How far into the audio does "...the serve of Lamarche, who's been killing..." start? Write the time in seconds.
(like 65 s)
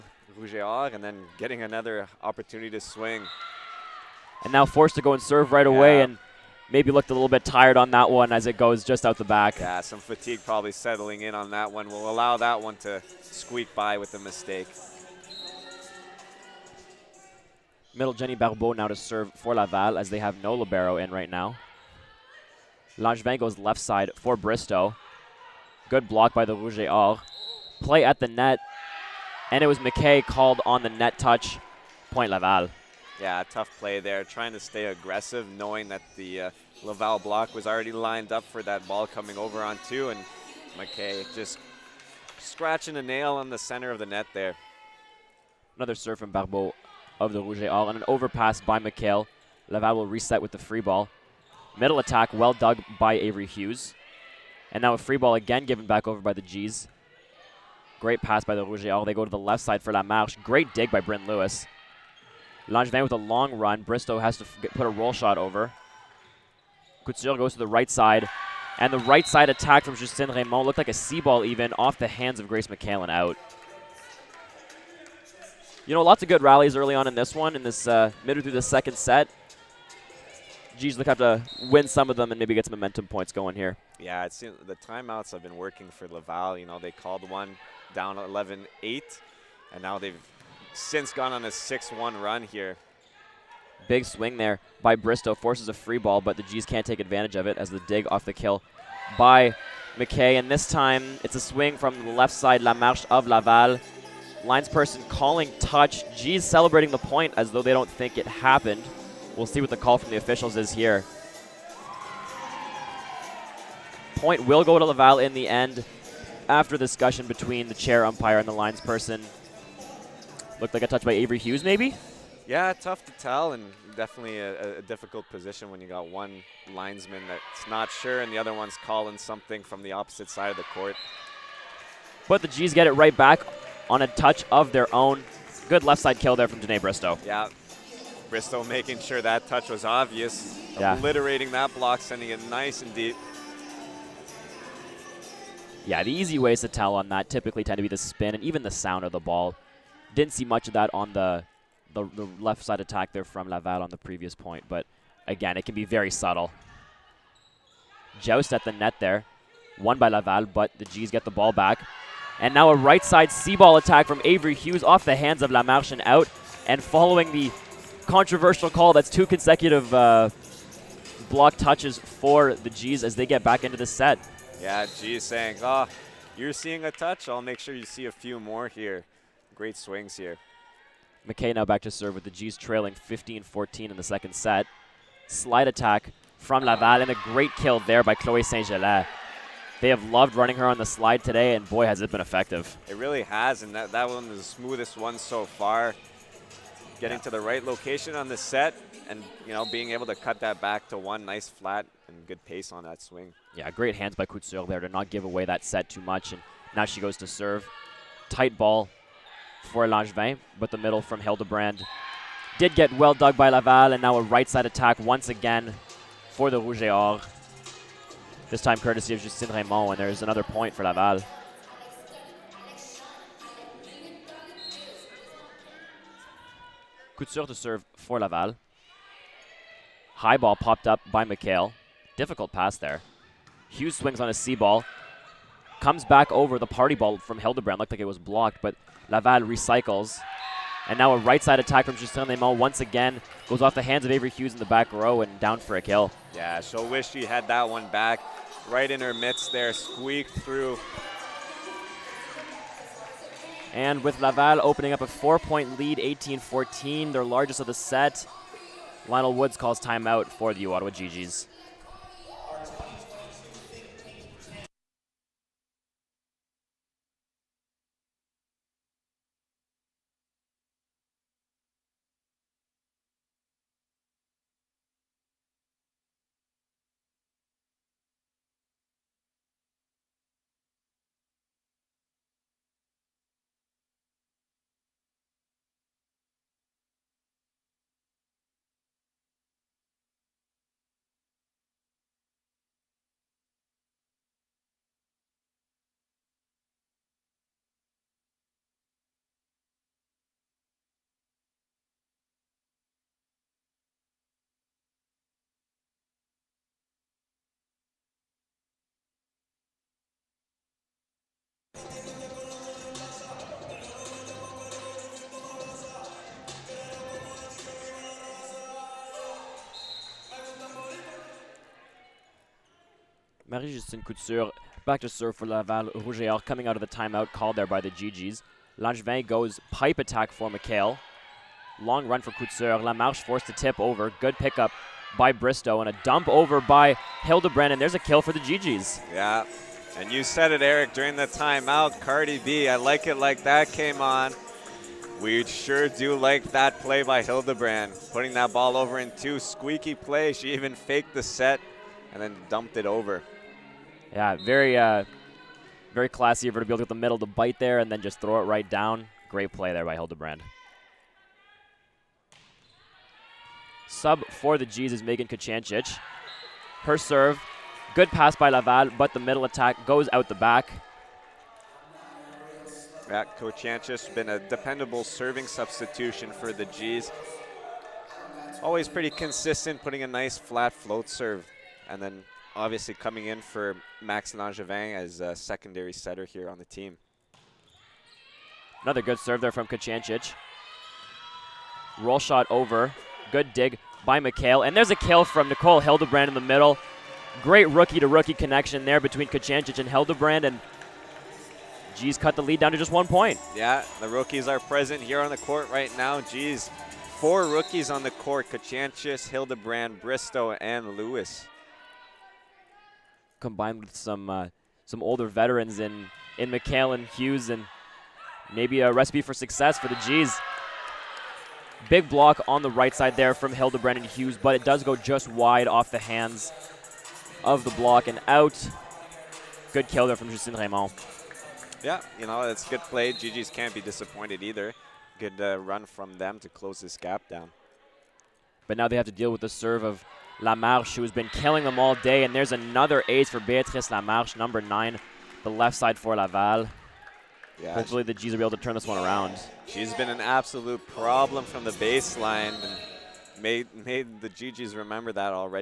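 439 s.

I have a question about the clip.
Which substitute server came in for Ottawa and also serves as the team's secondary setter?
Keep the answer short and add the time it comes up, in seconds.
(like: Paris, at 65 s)
Megan Kachanchich, at 365 s.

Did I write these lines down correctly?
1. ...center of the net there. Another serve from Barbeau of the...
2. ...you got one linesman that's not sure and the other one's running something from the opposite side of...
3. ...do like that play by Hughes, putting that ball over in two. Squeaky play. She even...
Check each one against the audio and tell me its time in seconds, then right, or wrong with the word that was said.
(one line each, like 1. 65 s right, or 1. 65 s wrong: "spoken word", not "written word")
1. 43 s right
2. 125 s wrong: "calling", not "running"
3. 345 s wrong: "Hildebrand", not "Hughes".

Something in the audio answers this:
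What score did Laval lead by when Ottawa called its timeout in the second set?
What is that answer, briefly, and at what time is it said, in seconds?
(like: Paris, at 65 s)
18-14, at 255 s.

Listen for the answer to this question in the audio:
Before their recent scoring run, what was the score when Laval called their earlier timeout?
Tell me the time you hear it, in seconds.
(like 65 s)
88 s.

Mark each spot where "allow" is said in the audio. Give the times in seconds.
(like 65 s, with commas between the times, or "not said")
12 s.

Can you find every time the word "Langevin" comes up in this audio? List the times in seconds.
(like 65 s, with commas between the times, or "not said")
22 s, 62 s, 209 s, 328 s, 384 s.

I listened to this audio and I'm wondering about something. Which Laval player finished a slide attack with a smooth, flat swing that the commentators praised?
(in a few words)
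Chloe Saint-Gelais.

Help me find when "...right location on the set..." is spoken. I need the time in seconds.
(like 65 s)
197 s.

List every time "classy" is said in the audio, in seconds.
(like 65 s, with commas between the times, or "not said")
356 s.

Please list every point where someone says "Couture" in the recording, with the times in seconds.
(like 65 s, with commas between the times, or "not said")
67 s, 204 s, 227 s, 324 s, 332 s.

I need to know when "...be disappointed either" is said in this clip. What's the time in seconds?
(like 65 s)
433 s.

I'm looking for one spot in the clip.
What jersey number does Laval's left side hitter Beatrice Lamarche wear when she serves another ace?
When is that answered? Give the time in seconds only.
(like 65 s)
444 s.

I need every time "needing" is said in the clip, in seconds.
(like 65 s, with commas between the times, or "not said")
not said.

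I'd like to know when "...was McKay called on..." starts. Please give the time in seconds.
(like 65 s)
29 s.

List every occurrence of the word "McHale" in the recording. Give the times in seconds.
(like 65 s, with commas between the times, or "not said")
48 s, 231 s, 330 s, 394 s.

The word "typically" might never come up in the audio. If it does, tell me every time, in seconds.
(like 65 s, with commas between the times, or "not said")
147 s.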